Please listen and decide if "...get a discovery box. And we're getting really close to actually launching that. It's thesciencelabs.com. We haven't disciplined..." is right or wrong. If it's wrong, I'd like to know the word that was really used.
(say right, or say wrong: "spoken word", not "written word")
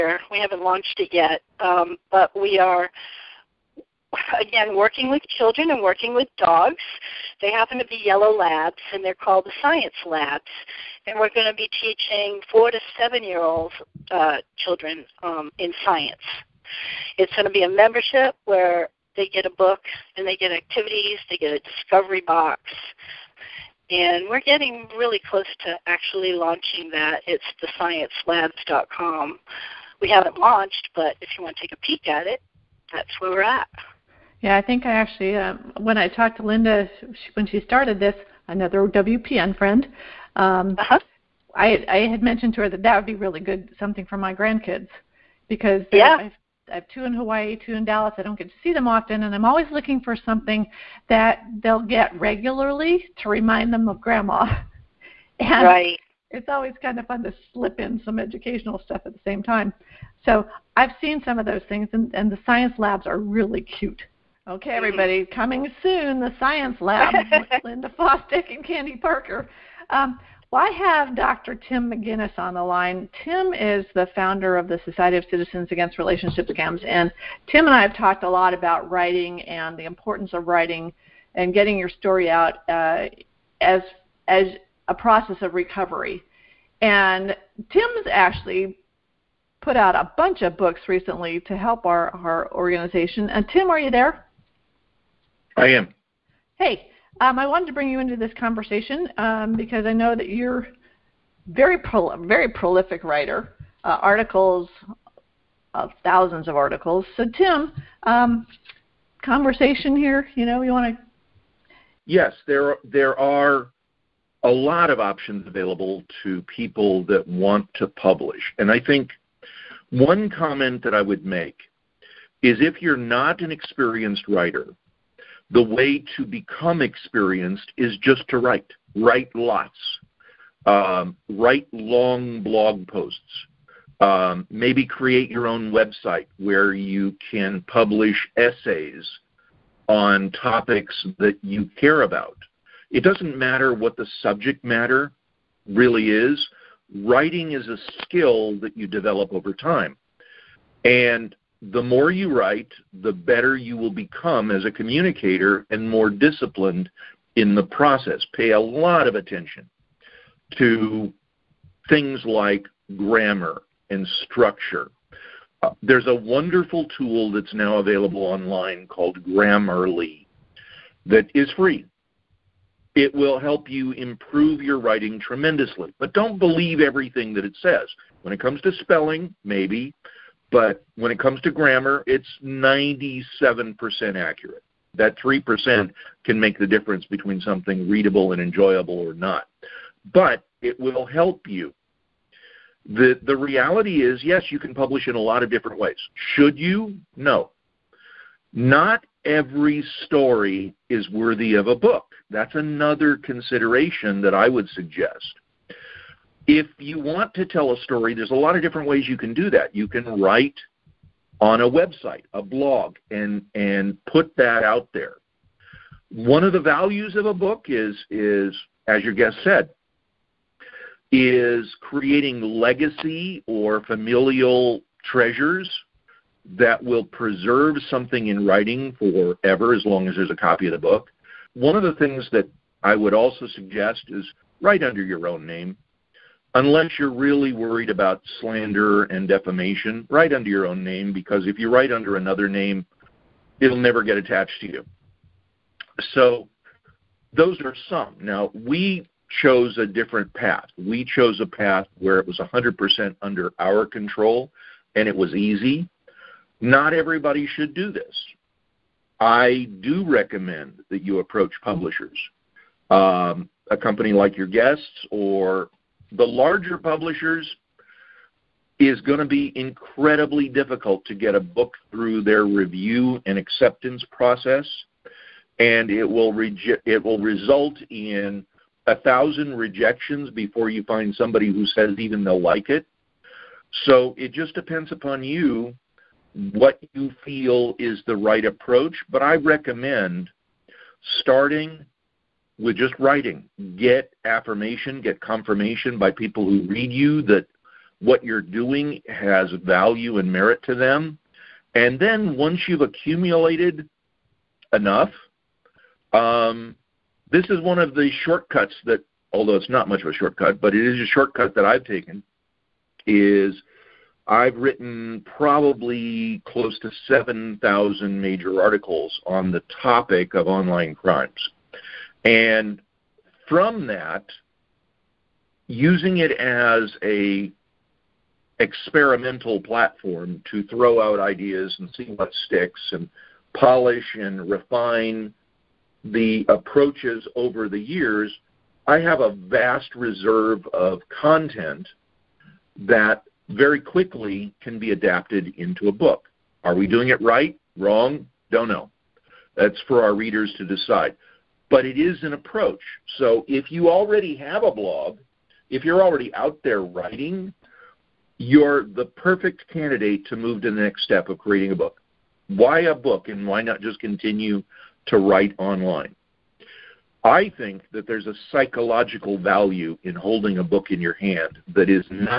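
wrong: "launched", not "disciplined".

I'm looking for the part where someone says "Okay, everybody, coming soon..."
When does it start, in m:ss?
1:04.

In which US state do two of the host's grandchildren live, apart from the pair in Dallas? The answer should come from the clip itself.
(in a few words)
Hawaii.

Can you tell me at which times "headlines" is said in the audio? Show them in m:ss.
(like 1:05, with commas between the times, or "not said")
not said.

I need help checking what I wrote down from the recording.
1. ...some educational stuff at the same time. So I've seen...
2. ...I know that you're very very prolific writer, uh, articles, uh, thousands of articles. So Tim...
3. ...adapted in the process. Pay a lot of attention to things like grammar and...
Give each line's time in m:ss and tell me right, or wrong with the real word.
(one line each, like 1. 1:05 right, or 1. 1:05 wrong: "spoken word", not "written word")
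1. 0:58 right
2. 1:39 right
3. 2:36 wrong: "disciplined", not "adapted".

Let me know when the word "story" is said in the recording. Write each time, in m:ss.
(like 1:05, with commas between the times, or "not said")
1:21, 3:20, 3:27.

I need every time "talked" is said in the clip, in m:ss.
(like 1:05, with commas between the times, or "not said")
0:36, 1:17.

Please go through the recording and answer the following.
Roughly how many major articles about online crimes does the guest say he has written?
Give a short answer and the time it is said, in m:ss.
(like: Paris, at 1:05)
7,000, at 5:17.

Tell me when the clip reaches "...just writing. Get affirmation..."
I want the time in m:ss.
4:52.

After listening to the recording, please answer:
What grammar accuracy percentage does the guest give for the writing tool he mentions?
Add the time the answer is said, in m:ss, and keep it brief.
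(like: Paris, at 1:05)
97%, at 3:02.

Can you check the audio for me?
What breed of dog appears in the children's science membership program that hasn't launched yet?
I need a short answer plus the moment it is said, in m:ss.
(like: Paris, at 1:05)
yellow labs, at 0:08.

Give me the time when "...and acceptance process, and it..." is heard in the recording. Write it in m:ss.
4:33.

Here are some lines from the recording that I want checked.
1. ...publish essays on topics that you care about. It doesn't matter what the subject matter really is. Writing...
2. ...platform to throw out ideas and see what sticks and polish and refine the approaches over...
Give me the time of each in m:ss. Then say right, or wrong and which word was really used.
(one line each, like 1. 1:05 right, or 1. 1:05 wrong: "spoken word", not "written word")
1. 2:17 right
2. 5:29 right.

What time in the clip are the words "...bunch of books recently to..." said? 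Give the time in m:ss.
1:30.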